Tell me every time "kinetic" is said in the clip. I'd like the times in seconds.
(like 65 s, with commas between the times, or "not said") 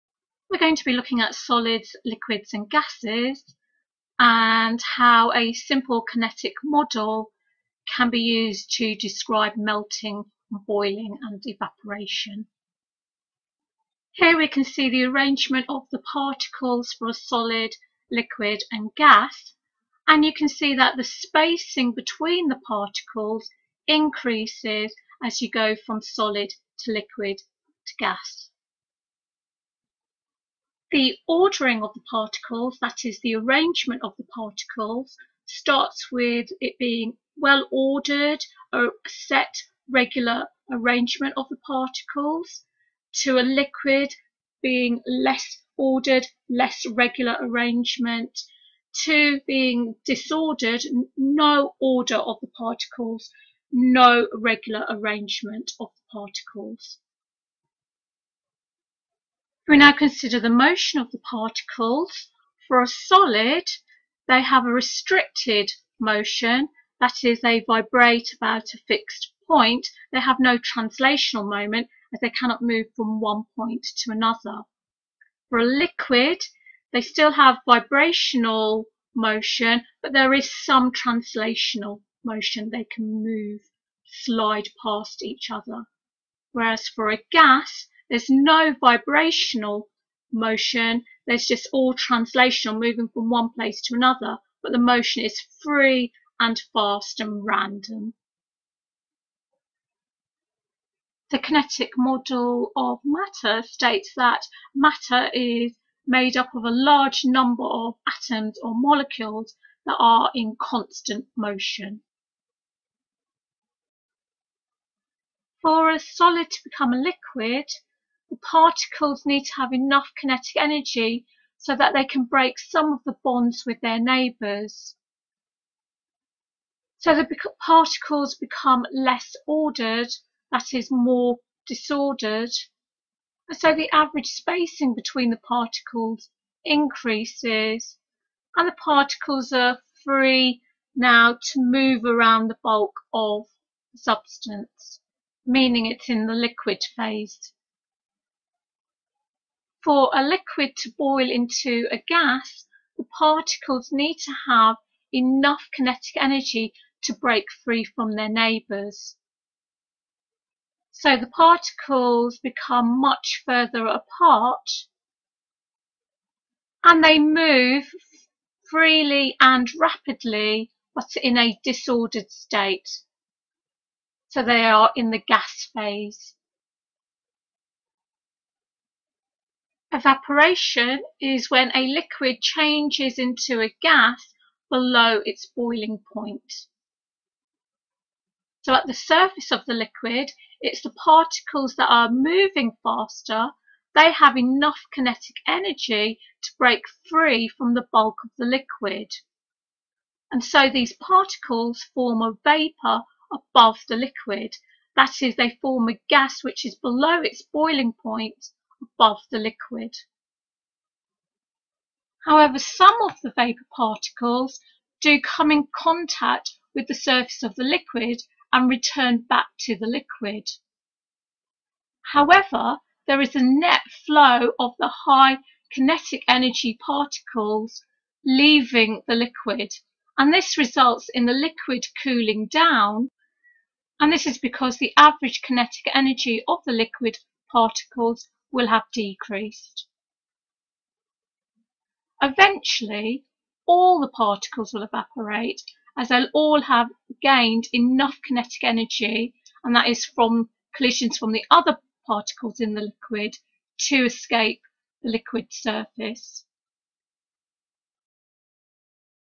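6 s, 101 s, 120 s, 155 s, 194 s, 225 s, 235 s, 248 s.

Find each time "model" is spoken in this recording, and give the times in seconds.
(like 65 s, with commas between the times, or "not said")
6 s, 101 s.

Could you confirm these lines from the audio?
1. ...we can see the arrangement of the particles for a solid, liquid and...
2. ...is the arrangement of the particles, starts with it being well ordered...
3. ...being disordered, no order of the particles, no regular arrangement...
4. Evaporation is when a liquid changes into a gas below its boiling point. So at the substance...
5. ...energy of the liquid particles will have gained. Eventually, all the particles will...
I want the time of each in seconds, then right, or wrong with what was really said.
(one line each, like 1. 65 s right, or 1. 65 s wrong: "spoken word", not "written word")
1. 14 s right
2. 33 s right
3. 49 s right
4. 179 s wrong: "surface", not "substance"
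5. 235 s wrong: "decreased", not "gained".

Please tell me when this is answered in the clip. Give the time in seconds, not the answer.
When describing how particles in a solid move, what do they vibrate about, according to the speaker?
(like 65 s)
68 s.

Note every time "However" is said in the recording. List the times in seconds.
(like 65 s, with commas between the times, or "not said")
212 s, 222 s.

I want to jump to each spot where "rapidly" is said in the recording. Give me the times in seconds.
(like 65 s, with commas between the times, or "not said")
169 s.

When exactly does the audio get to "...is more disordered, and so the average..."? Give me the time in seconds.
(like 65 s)
130 s.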